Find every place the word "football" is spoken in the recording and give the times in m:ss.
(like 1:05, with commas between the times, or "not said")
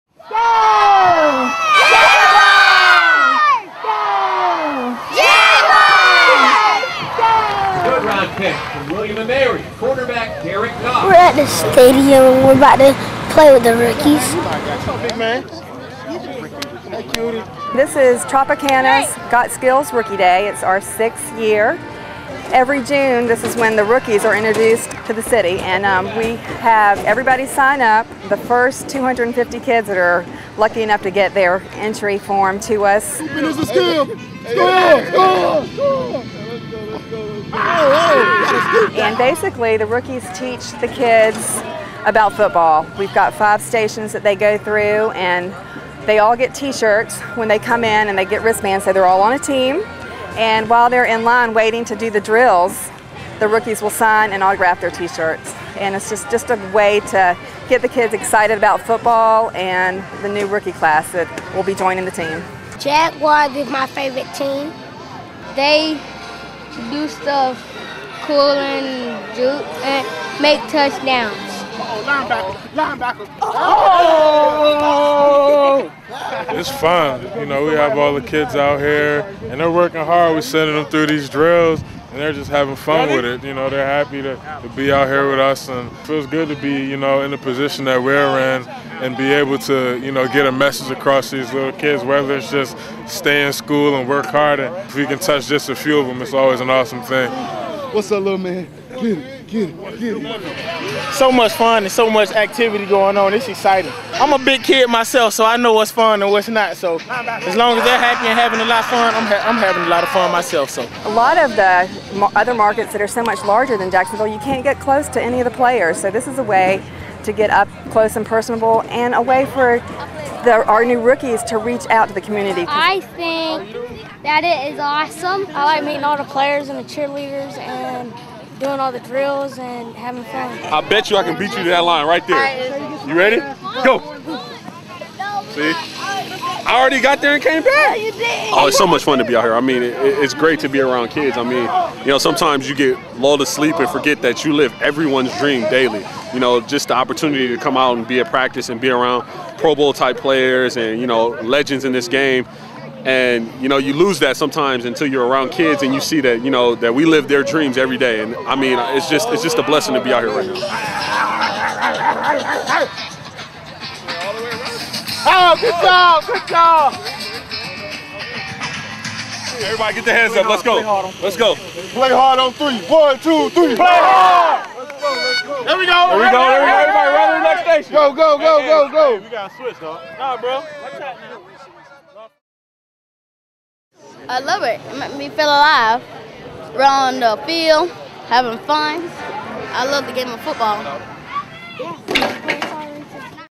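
0:42, 0:58, 3:11.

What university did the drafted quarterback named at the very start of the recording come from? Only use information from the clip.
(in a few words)
William and Mary.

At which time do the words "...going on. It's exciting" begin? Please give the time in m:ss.
1:42.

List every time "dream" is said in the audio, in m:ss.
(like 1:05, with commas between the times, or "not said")
2:25, 2:37.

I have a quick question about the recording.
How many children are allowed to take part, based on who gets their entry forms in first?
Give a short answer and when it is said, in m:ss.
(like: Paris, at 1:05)
250, at 0:28.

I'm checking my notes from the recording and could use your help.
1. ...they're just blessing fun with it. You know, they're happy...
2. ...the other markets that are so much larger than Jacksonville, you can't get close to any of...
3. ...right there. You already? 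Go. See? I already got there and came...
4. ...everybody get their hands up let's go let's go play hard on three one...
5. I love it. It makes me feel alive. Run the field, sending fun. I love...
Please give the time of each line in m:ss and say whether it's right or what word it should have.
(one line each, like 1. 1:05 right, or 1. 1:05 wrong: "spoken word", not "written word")
1. 1:22 wrong: "having", not "blessing"
2. 1:51 right
3. 2:12 wrong: "ready", not "already"
4. 2:49 right
5. 3:04 wrong: "having", not "sending".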